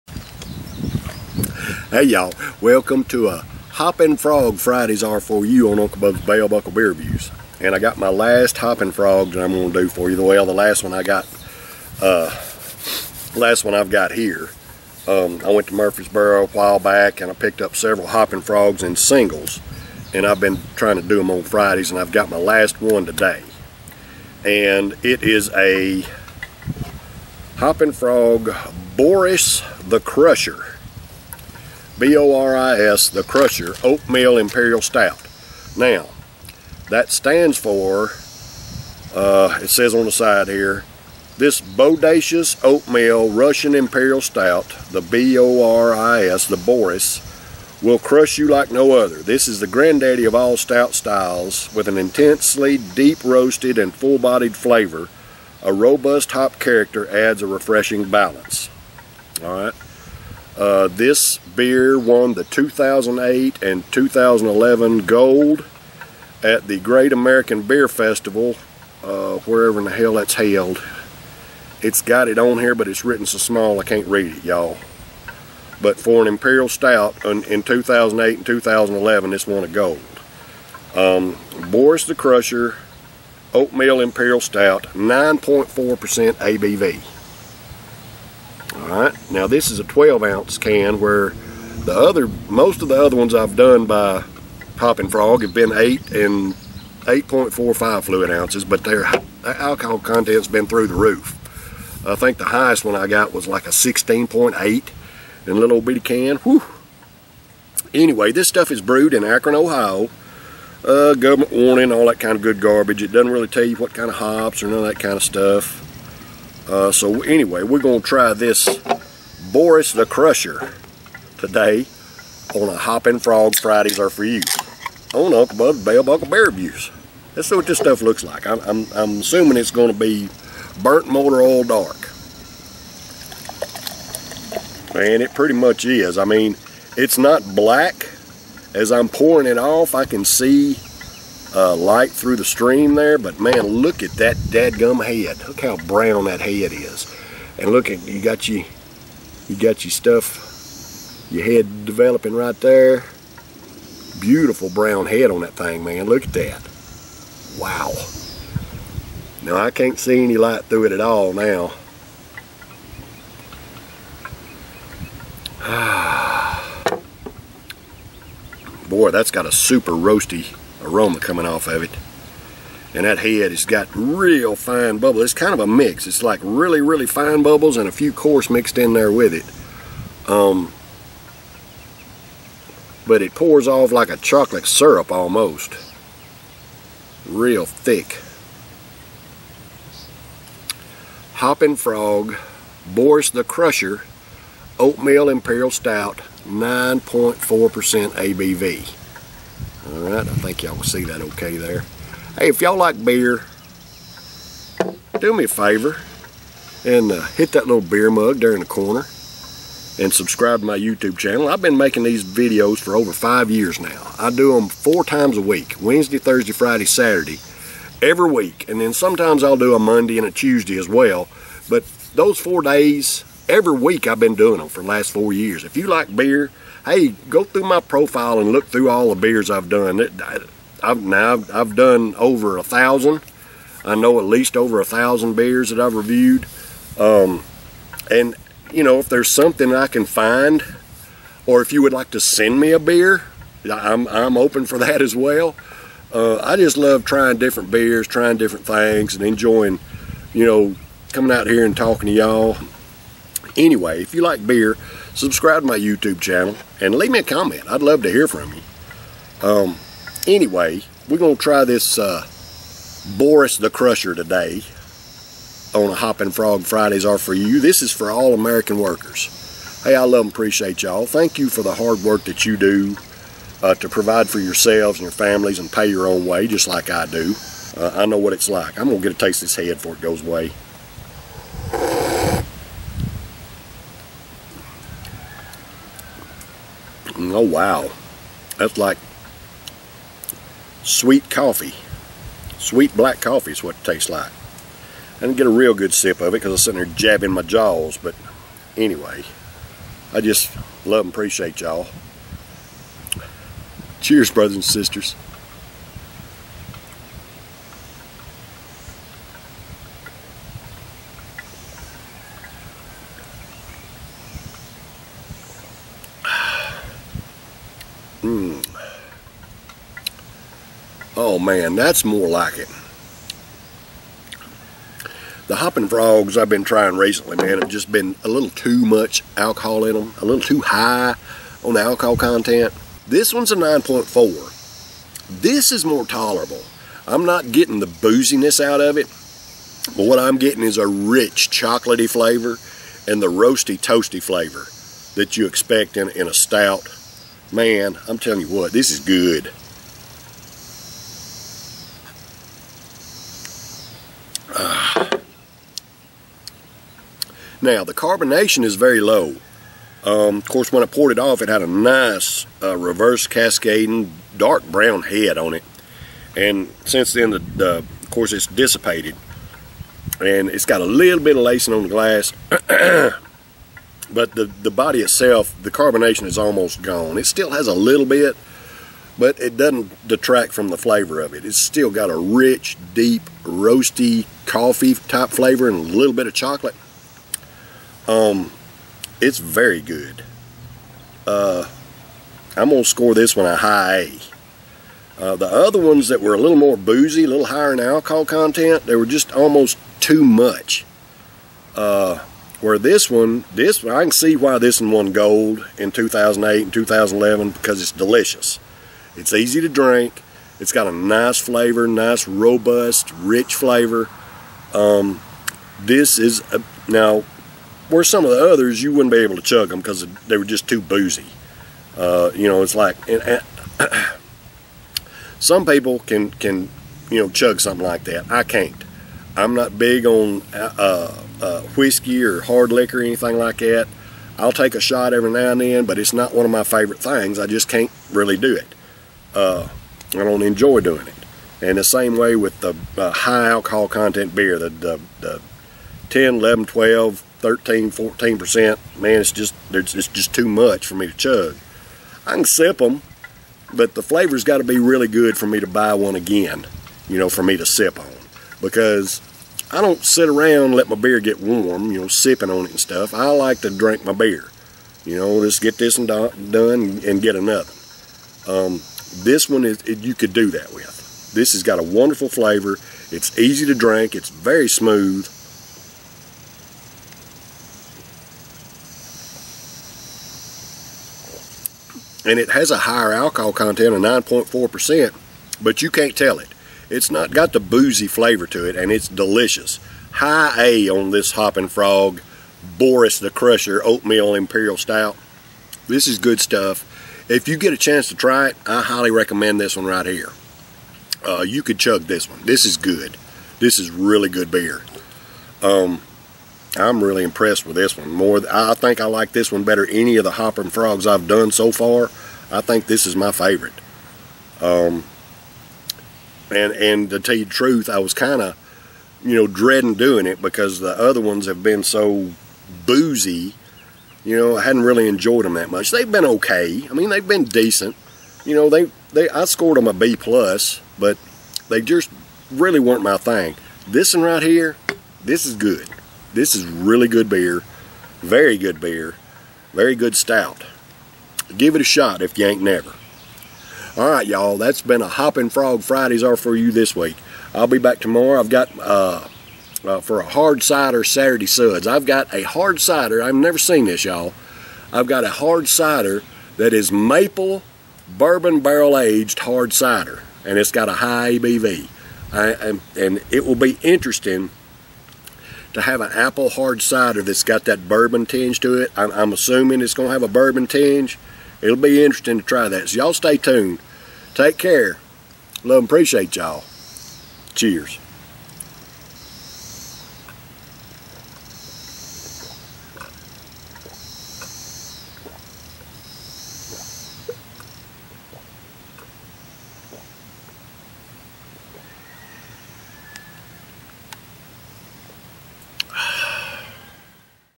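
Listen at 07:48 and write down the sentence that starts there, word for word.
Um, this one, is you could do that with.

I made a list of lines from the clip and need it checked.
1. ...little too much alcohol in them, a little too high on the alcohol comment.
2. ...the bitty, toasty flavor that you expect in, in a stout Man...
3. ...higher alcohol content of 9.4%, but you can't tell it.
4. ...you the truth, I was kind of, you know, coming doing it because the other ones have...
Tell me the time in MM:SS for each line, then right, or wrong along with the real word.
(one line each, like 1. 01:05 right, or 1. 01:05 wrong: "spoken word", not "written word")
1. 05:28 wrong: "content", not "comment"
2. 05:43 wrong: "roasty", not "bitty"
3. 08:02 right
4. 08:37 wrong: "dreading", not "coming".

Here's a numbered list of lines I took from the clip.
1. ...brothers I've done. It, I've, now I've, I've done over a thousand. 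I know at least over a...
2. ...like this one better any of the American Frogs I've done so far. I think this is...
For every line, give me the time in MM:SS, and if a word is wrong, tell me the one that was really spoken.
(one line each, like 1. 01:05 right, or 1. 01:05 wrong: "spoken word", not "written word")
1. 03:49 wrong: "beers", not "brothers"
2. 08:29 wrong: "Hopping", not "American".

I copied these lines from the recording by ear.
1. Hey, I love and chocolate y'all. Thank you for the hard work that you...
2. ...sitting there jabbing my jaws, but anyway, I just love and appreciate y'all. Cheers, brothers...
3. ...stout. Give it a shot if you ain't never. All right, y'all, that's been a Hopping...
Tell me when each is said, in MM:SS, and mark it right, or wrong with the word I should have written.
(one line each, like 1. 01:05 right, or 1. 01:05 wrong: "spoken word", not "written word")
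1. 04:29 wrong: "appreciate", not "chocolate"
2. 04:56 right
3. 09:00 right.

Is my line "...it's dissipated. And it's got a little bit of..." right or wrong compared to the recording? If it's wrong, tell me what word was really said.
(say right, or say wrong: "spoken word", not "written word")
right.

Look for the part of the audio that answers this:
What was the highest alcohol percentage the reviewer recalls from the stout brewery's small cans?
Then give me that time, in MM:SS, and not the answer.
01:43.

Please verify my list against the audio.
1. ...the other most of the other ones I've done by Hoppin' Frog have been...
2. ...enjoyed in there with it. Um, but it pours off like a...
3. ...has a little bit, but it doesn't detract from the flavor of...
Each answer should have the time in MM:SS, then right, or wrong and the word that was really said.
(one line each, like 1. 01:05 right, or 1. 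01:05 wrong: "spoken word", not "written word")
1. 01:31 right
2. 02:58 wrong: "mixed", not "enjoyed"
3. 06:17 right.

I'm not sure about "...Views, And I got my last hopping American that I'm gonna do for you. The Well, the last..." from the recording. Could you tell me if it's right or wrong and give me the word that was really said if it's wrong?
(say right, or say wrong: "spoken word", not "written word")
wrong: "Frog", not "American".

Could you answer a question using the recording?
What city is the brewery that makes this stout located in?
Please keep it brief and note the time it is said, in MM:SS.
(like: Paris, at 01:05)
Akron, Ohio, at 01:49.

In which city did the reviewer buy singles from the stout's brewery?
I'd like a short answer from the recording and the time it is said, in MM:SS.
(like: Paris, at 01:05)
Murfreesboro, at 00:15.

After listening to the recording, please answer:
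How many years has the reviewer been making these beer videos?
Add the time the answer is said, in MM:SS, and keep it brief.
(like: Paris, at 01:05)
over 5 years, at 03:33.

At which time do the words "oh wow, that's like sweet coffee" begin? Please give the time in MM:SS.
04:47.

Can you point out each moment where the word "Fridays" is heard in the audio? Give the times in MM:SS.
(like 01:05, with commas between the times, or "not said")
00:04, 00:21, 02:03, 03:36, 04:26, 09:05.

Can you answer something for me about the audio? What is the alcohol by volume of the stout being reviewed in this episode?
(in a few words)
9.4%.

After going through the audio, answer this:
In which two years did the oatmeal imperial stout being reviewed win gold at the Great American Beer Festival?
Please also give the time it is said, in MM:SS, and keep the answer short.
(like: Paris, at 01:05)
2008 and 2011, at 01:02.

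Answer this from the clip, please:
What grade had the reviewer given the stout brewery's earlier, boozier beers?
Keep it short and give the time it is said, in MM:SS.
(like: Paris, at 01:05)
B plus, at 08:49.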